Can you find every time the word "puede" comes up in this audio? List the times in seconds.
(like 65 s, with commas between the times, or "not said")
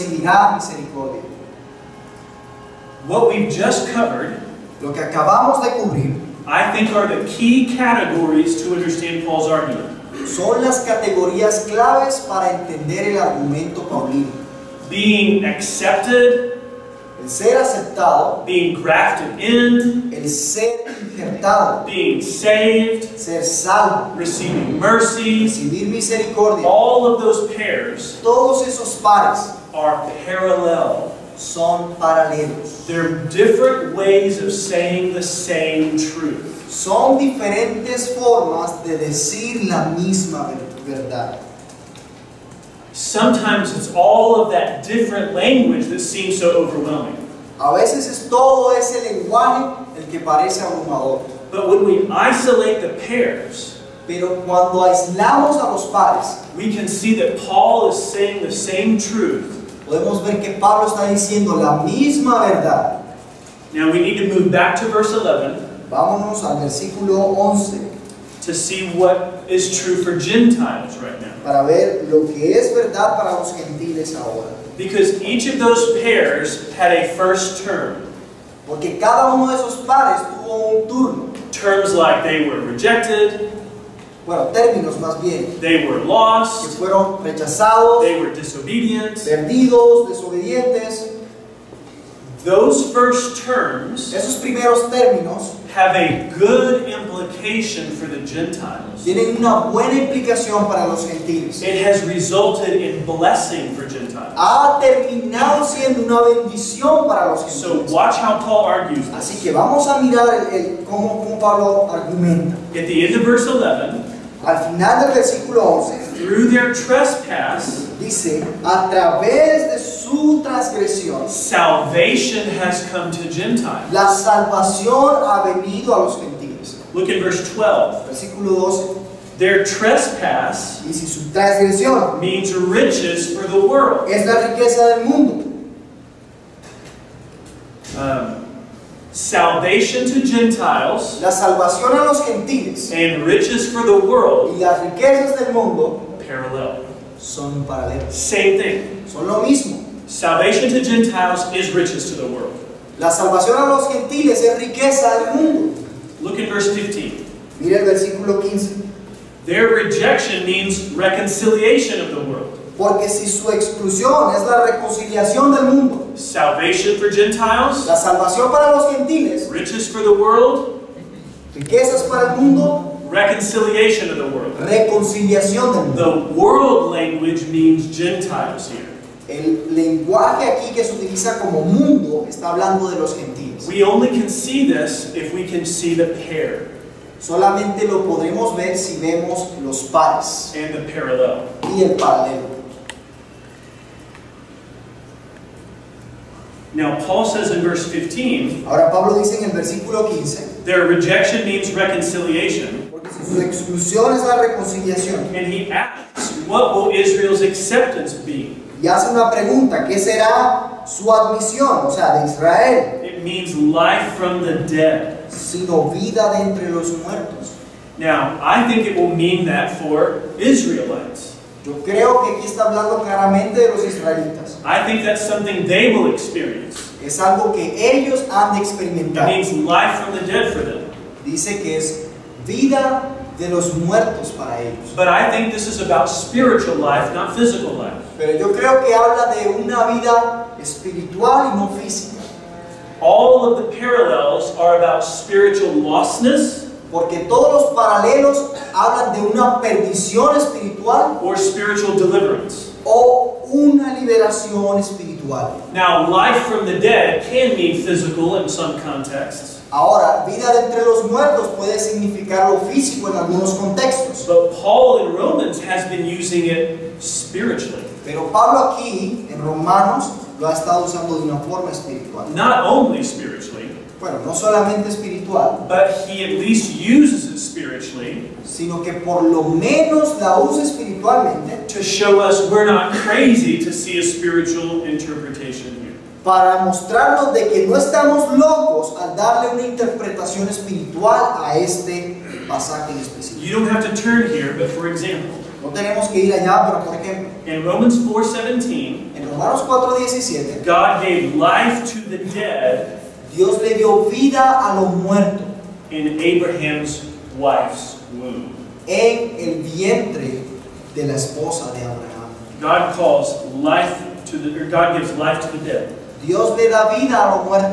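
261 s.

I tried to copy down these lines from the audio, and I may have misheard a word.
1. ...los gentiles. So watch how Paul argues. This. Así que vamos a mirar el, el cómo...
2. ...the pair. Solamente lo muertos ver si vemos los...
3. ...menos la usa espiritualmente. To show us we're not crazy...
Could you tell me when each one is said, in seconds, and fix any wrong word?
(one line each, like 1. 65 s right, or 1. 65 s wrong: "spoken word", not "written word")
1. 107 s right
2. 185 s wrong: "podremos", not "muertos"
3. 279 s right.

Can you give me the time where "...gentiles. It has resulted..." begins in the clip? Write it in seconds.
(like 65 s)
101 s.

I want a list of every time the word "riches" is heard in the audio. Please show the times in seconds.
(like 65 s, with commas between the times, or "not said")
132 s, 143 s, 151 s, 169 s.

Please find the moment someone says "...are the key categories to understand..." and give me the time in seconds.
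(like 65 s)
6 s.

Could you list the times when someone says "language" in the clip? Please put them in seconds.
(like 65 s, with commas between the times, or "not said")
45 s, 176 s.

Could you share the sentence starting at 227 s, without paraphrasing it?
Es algo que ellos han de experimentar.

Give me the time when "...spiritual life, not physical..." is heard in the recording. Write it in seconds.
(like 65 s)
236 s.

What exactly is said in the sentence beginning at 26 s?
All of those pairs, todos esos pares, are parallel.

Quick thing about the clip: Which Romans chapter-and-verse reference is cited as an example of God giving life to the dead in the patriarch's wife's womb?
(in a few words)
Romans 4:17.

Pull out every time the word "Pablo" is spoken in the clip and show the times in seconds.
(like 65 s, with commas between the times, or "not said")
60 s, 111 s, 198 s, 268 s.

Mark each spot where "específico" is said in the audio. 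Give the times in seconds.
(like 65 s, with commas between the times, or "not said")
292 s.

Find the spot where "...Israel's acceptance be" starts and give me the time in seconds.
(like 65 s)
206 s.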